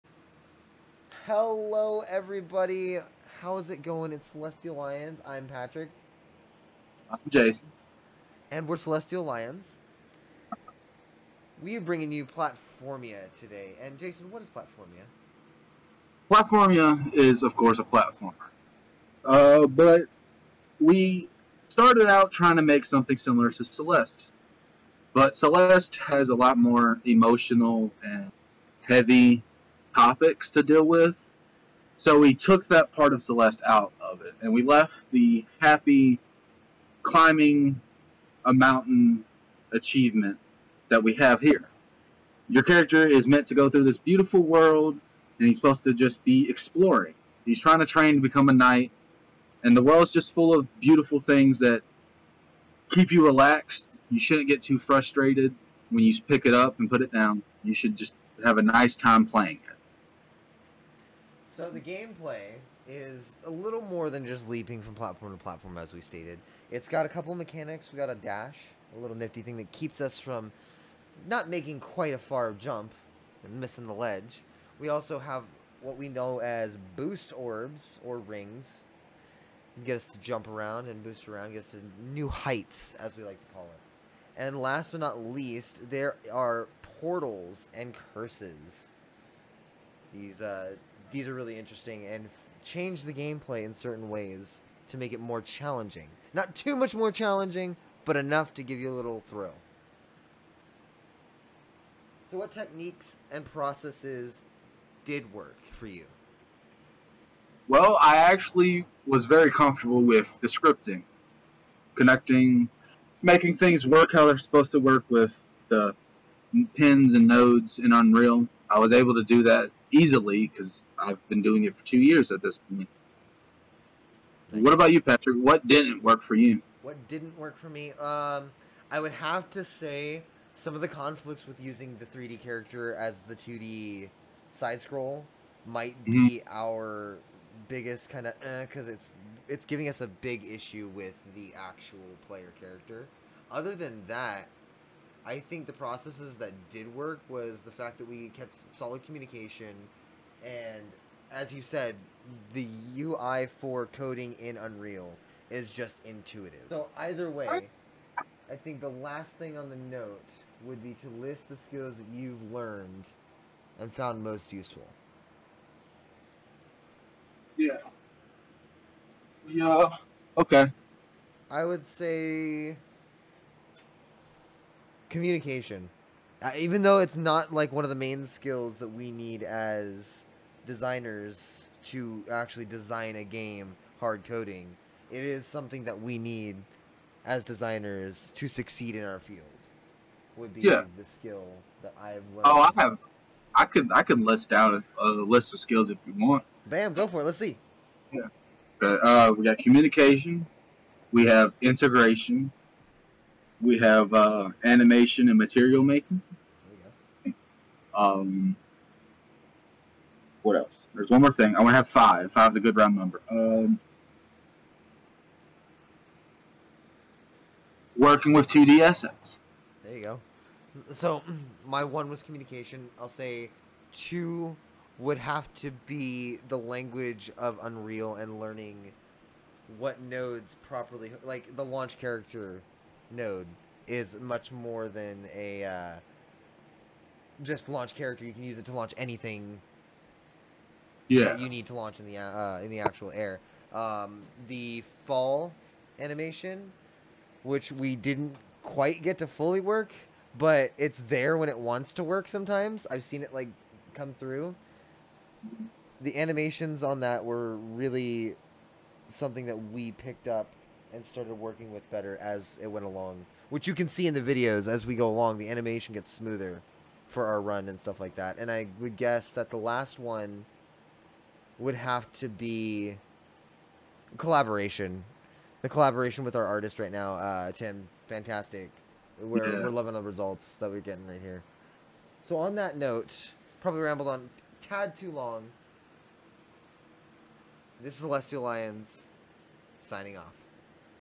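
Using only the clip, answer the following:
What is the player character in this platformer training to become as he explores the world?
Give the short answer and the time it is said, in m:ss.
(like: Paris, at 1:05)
A knight, at 0:48.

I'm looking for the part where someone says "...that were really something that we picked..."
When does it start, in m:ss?
4:17.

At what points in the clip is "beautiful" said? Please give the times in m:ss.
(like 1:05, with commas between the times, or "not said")
0:43, 0:50.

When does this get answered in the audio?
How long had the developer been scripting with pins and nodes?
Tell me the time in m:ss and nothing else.
2:01.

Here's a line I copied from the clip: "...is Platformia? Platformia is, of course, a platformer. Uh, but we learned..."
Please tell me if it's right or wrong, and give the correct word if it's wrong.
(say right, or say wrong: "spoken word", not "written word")
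wrong: "started", not "learned".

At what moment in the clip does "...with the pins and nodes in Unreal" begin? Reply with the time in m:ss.
1:55.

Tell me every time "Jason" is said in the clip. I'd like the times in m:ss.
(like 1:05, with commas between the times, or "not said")
0:07, 0:13.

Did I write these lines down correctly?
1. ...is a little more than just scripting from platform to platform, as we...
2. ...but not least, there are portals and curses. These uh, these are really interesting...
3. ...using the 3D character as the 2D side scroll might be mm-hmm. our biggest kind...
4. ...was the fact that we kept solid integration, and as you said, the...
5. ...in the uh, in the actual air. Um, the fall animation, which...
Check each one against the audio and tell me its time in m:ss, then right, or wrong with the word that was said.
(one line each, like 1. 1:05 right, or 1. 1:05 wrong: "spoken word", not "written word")
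1. 1:02 wrong: "leaping", not "scripting"
2. 1:24 right
3. 2:11 right
4. 2:27 wrong: "communication", not "integration"
5. 4:01 right.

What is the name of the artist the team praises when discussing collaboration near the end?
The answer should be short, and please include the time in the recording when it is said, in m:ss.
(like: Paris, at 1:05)
Tim, at 4:37.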